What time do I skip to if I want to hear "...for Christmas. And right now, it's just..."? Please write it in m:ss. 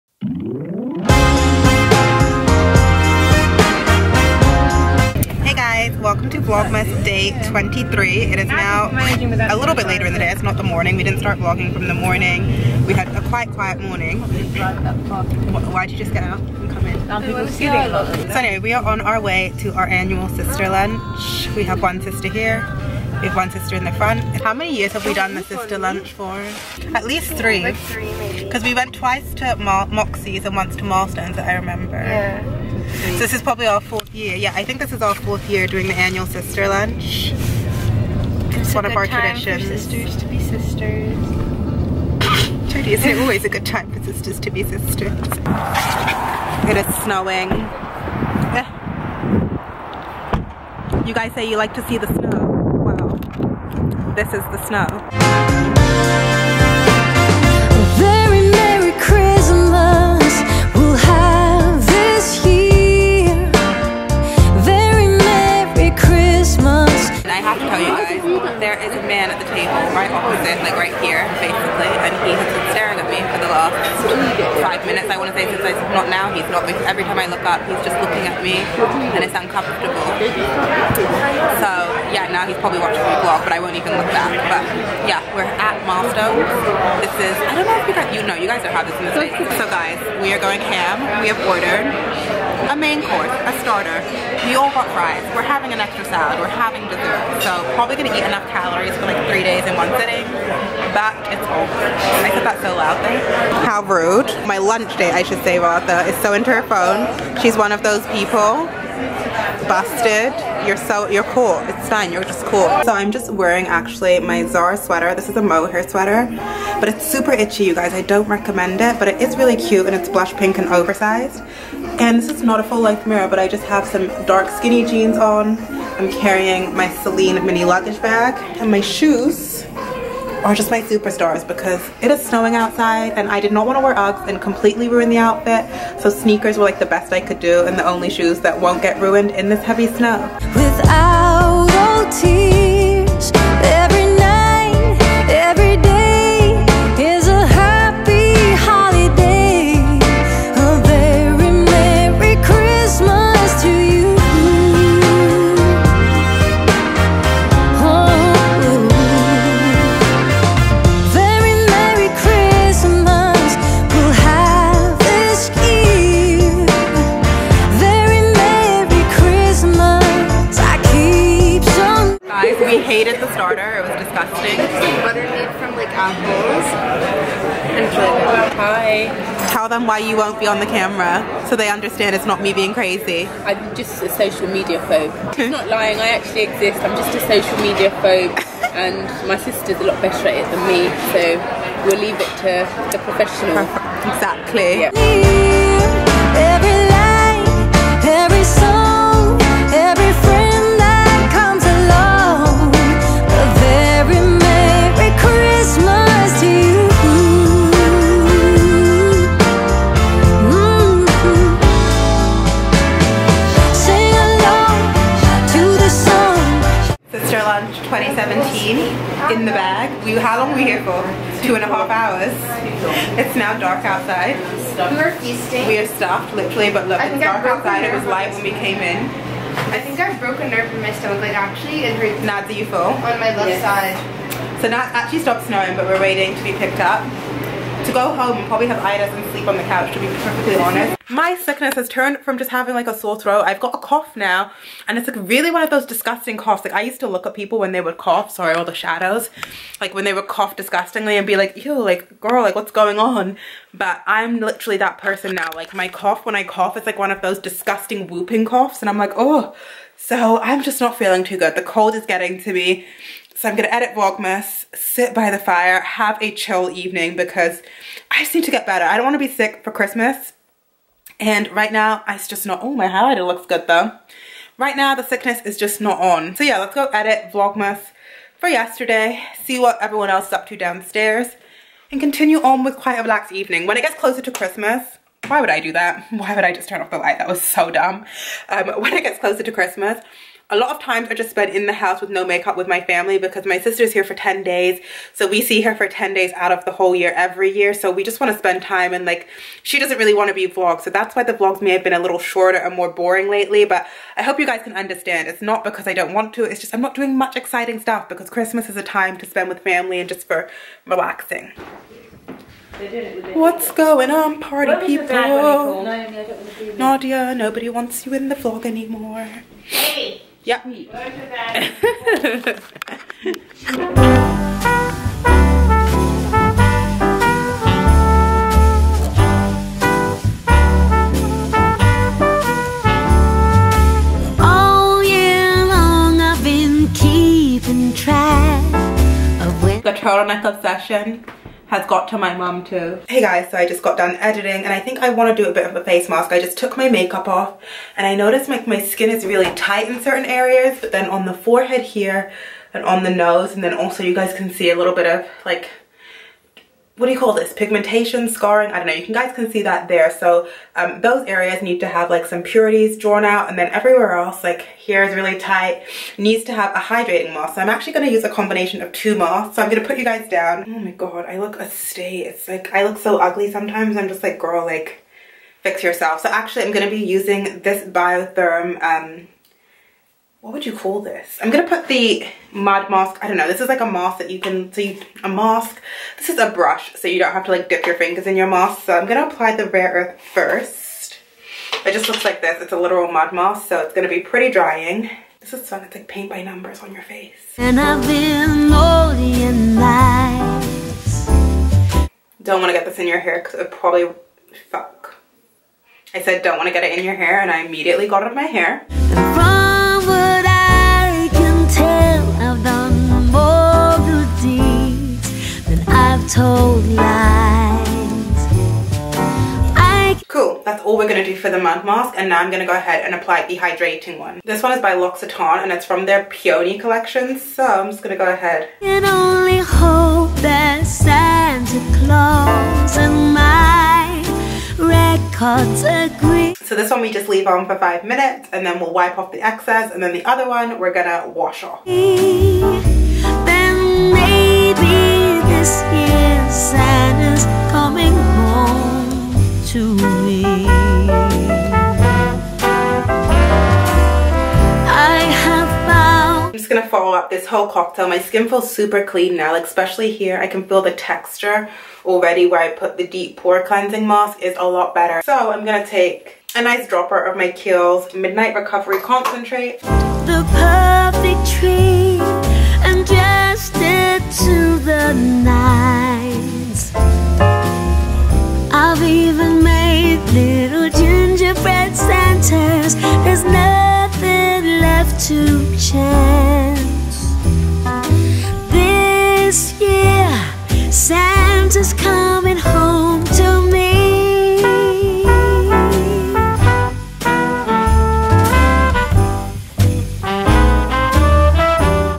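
4:29.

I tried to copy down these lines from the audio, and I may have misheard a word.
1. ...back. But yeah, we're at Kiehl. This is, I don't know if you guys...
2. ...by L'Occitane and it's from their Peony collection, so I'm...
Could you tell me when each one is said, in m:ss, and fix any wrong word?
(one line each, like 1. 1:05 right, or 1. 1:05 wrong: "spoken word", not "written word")
1. 1:24 wrong: "Milestones", not "Kiehl"
2. 7:04 right.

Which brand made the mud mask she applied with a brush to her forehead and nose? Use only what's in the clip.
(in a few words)
Biotherm.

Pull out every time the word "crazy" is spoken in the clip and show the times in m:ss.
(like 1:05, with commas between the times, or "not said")
3:02.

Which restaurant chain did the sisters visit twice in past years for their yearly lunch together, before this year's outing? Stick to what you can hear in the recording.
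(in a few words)
Moxie's.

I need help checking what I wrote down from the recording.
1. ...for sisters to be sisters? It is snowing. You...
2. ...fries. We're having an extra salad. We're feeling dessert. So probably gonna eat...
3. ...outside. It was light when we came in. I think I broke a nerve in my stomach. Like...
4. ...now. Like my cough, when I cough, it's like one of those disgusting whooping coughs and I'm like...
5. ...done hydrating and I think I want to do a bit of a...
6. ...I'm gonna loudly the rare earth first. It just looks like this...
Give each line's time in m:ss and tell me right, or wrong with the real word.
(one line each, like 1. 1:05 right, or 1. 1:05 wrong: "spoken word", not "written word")
1. 0:43 right
2. 1:34 wrong: "having", not "feeling"
3. 3:47 right
4. 4:15 right
5. 5:43 wrong: "editing", not "hydrating"
6. 6:28 wrong: "apply", not "loudly".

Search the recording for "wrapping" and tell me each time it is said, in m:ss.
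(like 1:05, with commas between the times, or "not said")
not said.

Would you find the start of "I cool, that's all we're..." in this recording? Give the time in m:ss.
6:59.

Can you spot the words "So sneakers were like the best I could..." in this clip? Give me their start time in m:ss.
2:16.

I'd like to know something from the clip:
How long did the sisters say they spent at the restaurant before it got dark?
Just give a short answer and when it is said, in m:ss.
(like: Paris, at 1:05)
2 and a half hours, at 3:41.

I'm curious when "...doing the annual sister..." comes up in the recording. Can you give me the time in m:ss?
0:35.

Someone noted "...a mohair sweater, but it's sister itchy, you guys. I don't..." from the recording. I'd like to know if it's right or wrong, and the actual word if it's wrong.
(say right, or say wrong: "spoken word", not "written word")
wrong: "super", not "sister".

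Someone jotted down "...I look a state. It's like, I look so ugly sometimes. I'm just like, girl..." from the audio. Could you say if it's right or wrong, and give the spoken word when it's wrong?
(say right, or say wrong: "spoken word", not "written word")
right.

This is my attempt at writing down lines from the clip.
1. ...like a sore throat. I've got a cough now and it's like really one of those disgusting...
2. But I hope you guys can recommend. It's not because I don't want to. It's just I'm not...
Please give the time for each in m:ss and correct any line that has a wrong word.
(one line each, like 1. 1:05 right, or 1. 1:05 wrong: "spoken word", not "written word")
1. 4:02 right
2. 5:03 wrong: "understand", not "recommend".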